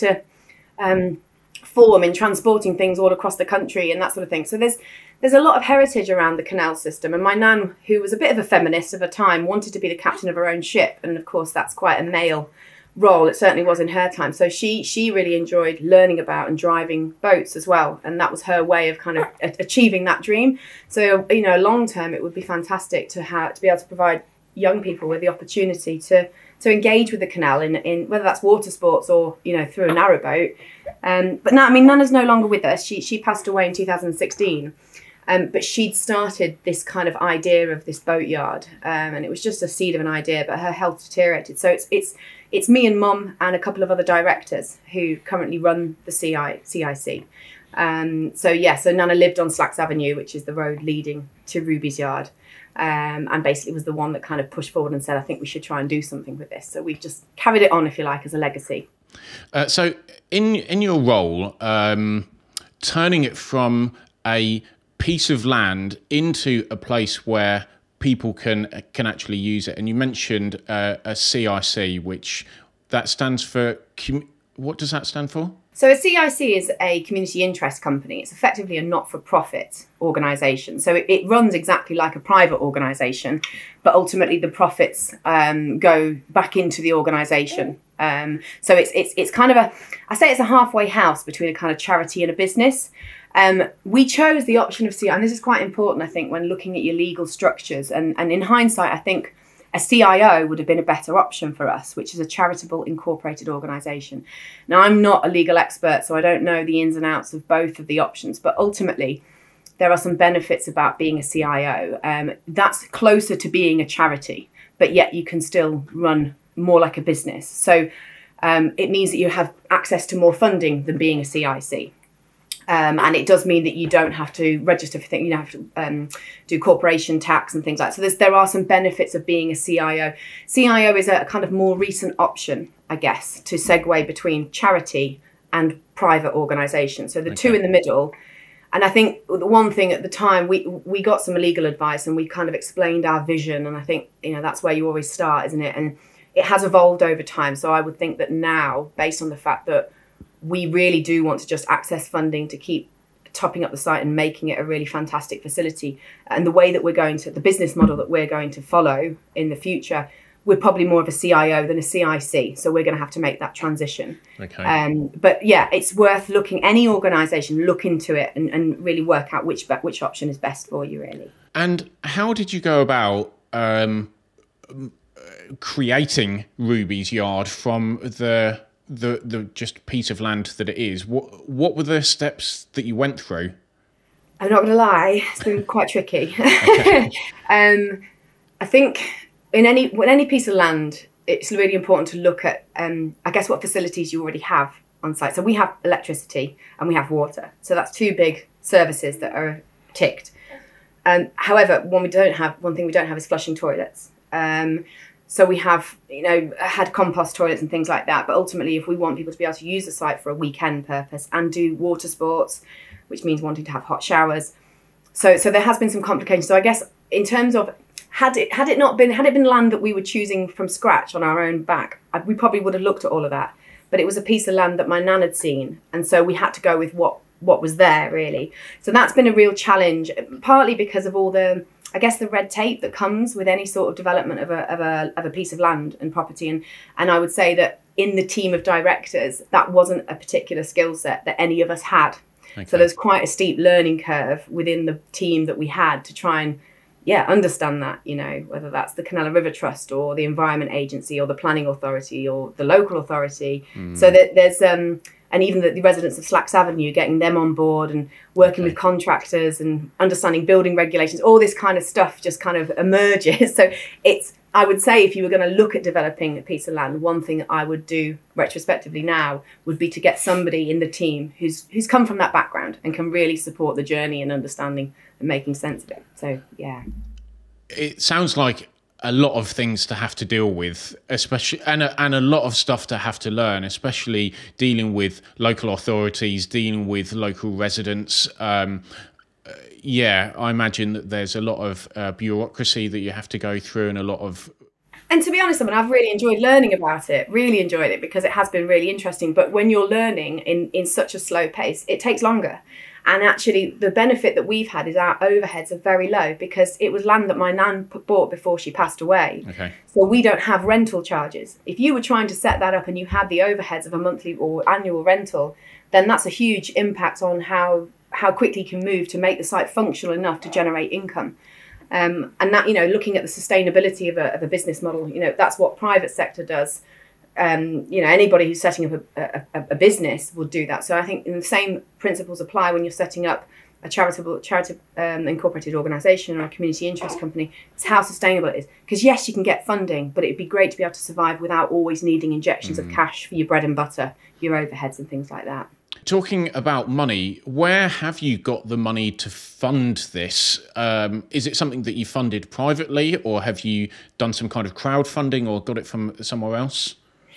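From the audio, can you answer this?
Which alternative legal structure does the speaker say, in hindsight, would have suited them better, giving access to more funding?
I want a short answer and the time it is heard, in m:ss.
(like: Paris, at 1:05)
Charitable incorporated organisation, at 1:42.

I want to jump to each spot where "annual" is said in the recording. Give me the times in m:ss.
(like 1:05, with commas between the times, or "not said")
5:14.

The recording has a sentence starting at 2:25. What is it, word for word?
And it has evolved over time.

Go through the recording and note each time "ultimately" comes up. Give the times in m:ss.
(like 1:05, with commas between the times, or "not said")
1:23, 1:48, 3:28.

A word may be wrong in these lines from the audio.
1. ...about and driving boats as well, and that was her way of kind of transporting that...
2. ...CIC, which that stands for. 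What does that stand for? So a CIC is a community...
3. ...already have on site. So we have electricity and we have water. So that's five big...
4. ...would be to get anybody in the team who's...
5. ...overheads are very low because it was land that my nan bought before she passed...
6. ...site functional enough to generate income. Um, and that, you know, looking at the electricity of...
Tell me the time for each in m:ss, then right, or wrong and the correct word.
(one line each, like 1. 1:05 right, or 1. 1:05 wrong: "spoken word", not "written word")
1. 0:16 wrong: "achieving", not "transporting"
2. 1:11 right
3. 3:14 wrong: "two", not "five"
4. 4:29 wrong: "somebody", not "anybody"
5. 5:05 right
6. 5:19 wrong: "sustainability", not "electricity".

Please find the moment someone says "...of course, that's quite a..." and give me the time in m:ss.
0:11.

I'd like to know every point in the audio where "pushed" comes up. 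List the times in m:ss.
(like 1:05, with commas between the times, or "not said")
0:54.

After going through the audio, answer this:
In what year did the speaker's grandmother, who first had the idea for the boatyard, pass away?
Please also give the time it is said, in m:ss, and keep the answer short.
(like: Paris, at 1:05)
2016, at 0:33.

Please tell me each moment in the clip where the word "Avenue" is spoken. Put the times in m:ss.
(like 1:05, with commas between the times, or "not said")
0:49, 4:16.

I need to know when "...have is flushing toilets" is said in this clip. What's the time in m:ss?
3:23.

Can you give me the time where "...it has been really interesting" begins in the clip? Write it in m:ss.
4:58.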